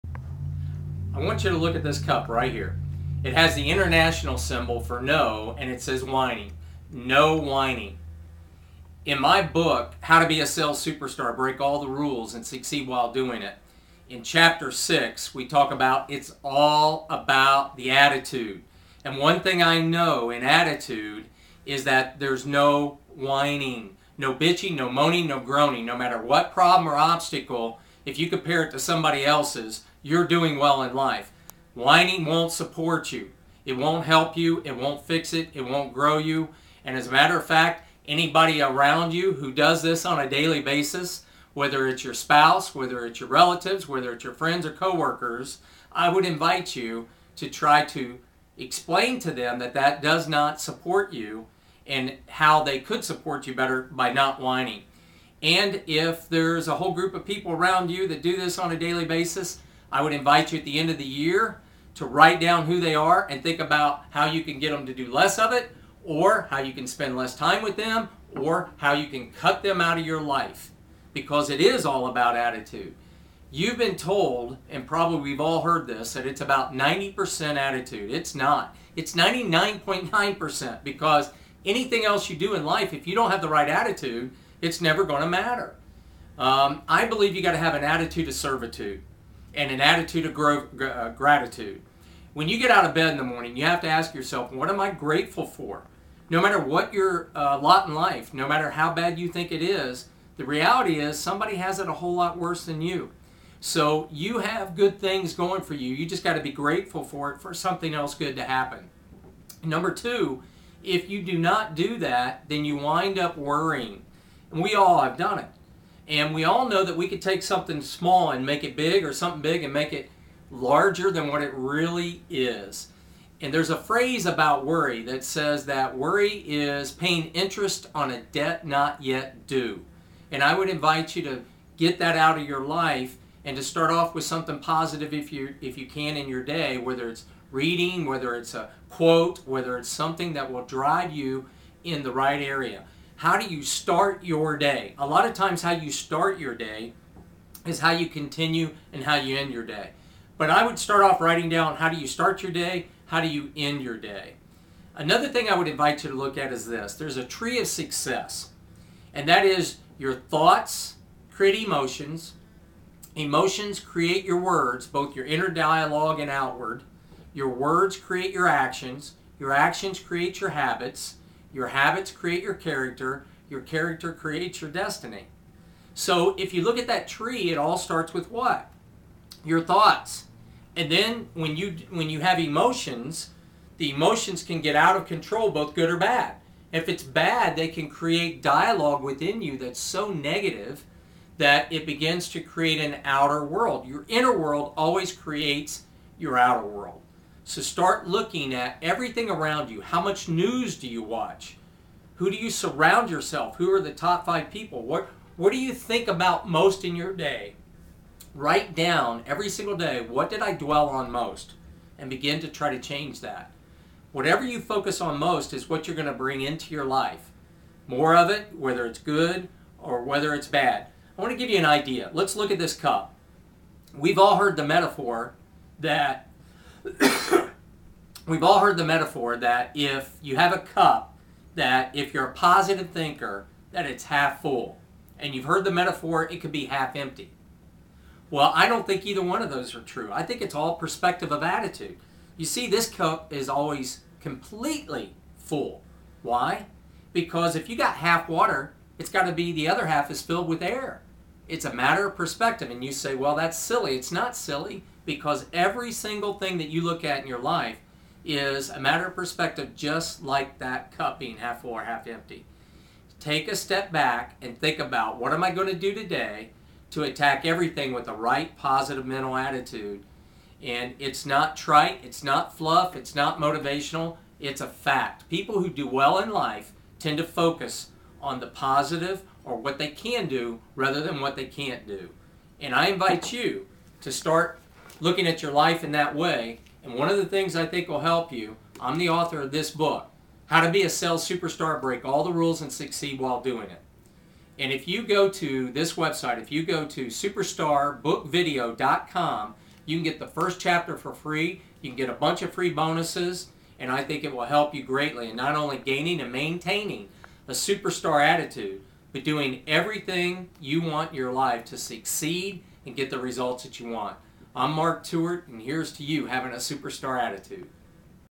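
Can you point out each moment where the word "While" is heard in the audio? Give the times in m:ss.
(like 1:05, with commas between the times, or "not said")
0:12, 4:53.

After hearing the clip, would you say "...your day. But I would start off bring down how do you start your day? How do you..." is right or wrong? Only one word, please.
wrong.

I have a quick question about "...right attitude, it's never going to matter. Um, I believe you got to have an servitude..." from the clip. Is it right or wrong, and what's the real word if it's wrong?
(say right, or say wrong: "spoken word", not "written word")
wrong: "attitude", not "servitude".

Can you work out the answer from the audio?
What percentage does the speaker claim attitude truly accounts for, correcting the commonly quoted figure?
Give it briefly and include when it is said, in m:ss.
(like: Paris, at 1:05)
99.9%, at 1:19.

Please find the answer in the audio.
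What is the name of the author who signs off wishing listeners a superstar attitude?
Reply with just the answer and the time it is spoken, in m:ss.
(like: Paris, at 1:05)
Mark Tewart, at 5:14.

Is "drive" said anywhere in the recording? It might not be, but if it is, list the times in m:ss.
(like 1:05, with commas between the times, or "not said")
2:20.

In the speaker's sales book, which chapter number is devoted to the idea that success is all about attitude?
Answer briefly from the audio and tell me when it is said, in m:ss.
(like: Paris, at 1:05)
6, at 0:14.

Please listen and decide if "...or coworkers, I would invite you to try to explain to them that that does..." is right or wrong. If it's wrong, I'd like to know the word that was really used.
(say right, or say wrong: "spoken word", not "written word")
right.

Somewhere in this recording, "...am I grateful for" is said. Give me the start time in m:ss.
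1:34.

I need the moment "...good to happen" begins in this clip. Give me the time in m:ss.
1:48.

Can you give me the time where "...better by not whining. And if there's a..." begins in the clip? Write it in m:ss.
0:53.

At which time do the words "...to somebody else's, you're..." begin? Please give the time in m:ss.
0:28.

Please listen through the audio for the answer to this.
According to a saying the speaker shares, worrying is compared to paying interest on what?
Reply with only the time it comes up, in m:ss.
2:08.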